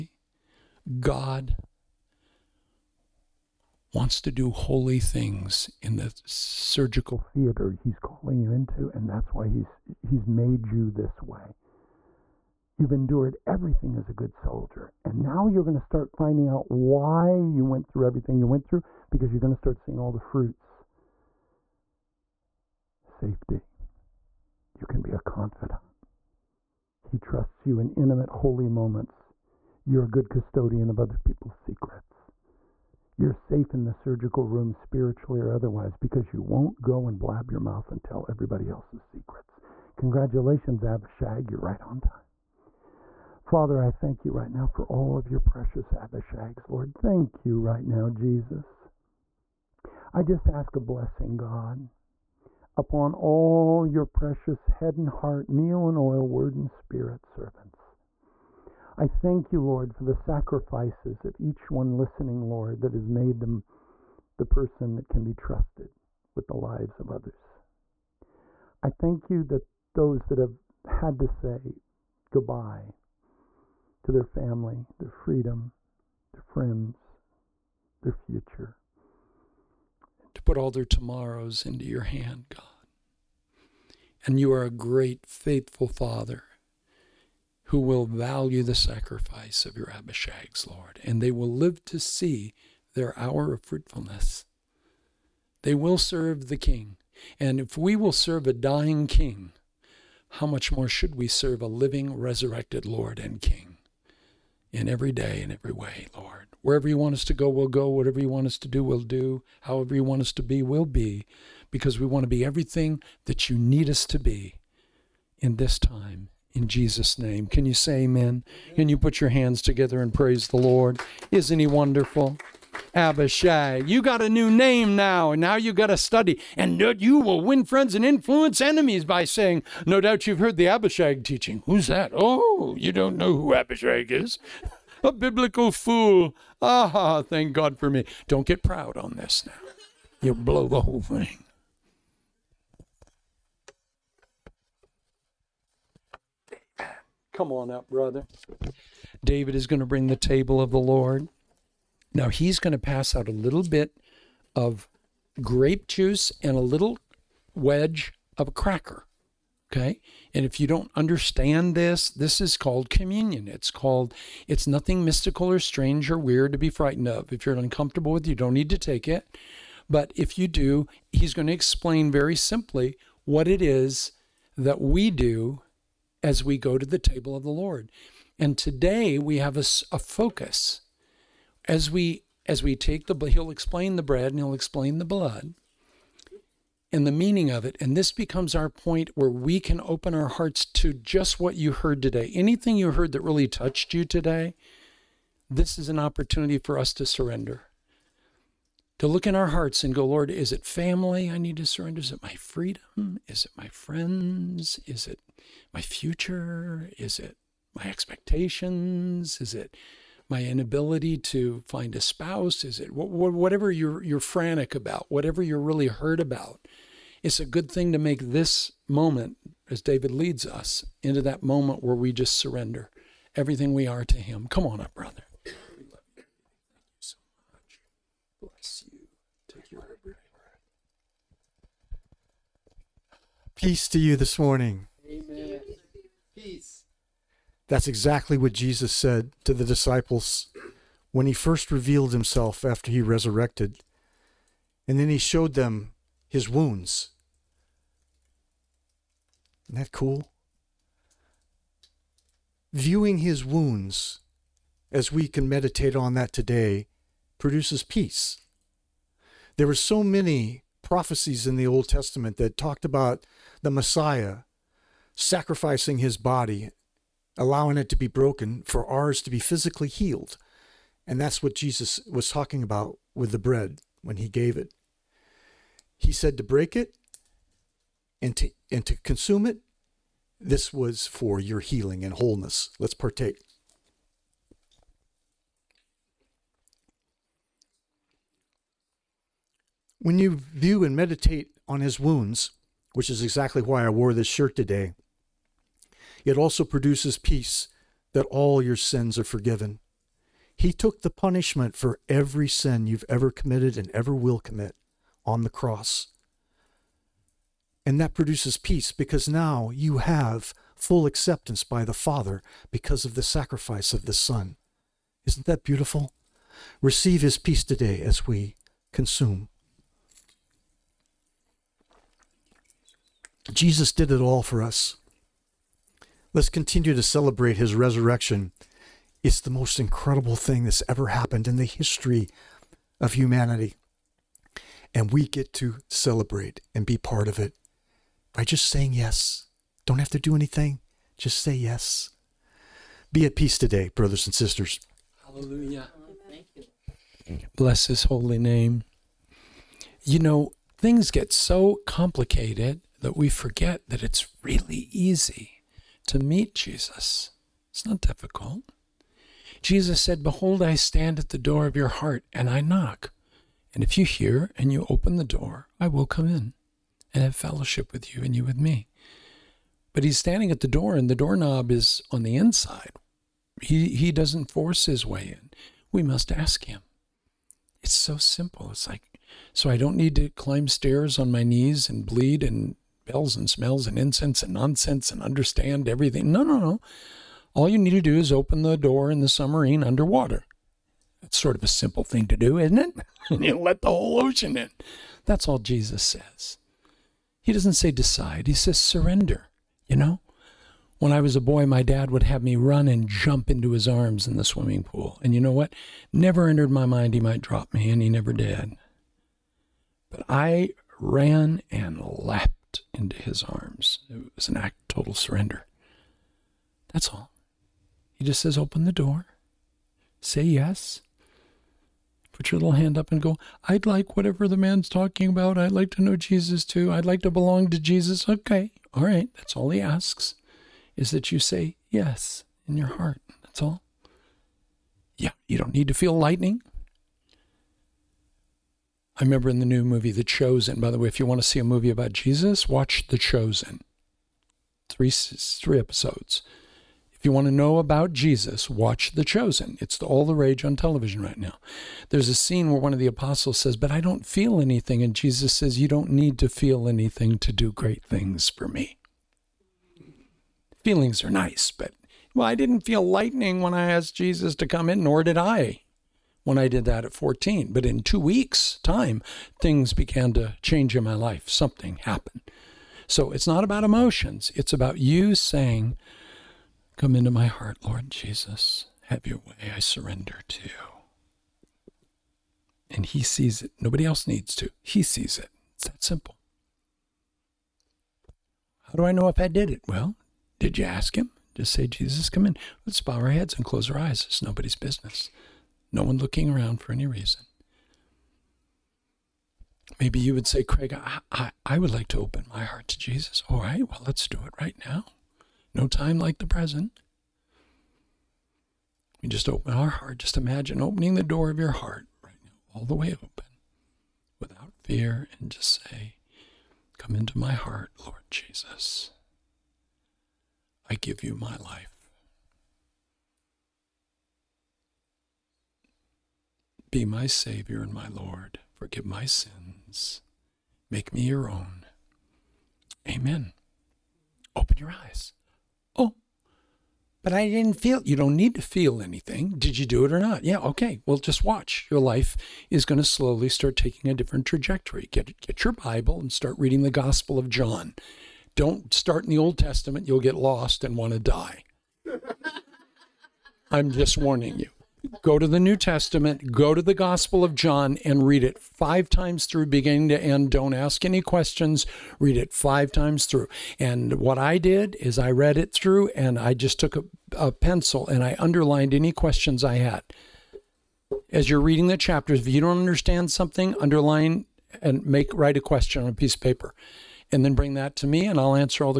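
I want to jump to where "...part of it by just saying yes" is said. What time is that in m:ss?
5:36.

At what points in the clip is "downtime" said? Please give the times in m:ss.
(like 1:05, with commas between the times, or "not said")
not said.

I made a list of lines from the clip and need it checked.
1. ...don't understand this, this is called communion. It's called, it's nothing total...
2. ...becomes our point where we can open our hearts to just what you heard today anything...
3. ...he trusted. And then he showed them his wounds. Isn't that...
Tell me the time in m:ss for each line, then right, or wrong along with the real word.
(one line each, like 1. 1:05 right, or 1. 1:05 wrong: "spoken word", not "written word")
1. 2:40 wrong: "mystical", not "total"
2. 3:08 right
3. 4:02 wrong: "resurrected", not "trusted".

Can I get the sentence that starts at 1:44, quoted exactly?
in every day, in every way, Lord.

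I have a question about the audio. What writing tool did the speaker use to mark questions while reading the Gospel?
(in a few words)
Pencil.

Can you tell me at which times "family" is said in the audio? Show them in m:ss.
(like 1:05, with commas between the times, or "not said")
1:14, 3:20.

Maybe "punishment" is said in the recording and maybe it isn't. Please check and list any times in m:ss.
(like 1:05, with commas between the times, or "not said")
5:01.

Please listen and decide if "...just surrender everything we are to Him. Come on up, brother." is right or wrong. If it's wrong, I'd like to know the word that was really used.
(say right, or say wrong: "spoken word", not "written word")
right.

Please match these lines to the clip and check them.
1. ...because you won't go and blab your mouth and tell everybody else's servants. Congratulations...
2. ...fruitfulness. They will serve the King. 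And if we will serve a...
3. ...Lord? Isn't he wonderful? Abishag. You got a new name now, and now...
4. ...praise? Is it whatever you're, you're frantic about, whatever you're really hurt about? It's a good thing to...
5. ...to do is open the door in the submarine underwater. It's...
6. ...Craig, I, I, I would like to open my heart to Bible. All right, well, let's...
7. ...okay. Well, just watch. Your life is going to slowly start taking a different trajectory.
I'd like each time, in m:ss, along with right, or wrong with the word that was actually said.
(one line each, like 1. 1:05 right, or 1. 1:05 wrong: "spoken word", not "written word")
1. 0:35 wrong: "secrets", not "servants"
2. 1:33 right
3. 2:00 right
4. 3:32 wrong: "spouse", not "praise"
5. 6:27 right
6. 8:20 wrong: "Jesus", not "Bible"
7. 9:00 right.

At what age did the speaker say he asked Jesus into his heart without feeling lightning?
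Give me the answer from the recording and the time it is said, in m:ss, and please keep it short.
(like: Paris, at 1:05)
14, at 7:47.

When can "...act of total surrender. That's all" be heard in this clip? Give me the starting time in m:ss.
6:54.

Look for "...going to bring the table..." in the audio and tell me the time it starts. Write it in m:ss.
2:29.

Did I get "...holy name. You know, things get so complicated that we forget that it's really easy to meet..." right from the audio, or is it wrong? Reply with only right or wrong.
right.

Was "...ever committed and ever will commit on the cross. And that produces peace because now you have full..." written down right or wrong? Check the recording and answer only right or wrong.
right.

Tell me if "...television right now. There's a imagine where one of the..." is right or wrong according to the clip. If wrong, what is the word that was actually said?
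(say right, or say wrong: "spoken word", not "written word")
wrong: "scene", not "imagine".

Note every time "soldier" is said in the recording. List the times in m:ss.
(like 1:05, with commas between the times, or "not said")
0:14.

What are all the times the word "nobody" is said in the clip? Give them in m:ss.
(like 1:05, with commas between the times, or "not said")
8:03, 8:14.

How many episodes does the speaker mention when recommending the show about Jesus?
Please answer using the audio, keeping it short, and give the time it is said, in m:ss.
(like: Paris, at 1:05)
3, at 7:24.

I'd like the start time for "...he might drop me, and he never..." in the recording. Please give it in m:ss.
6:47.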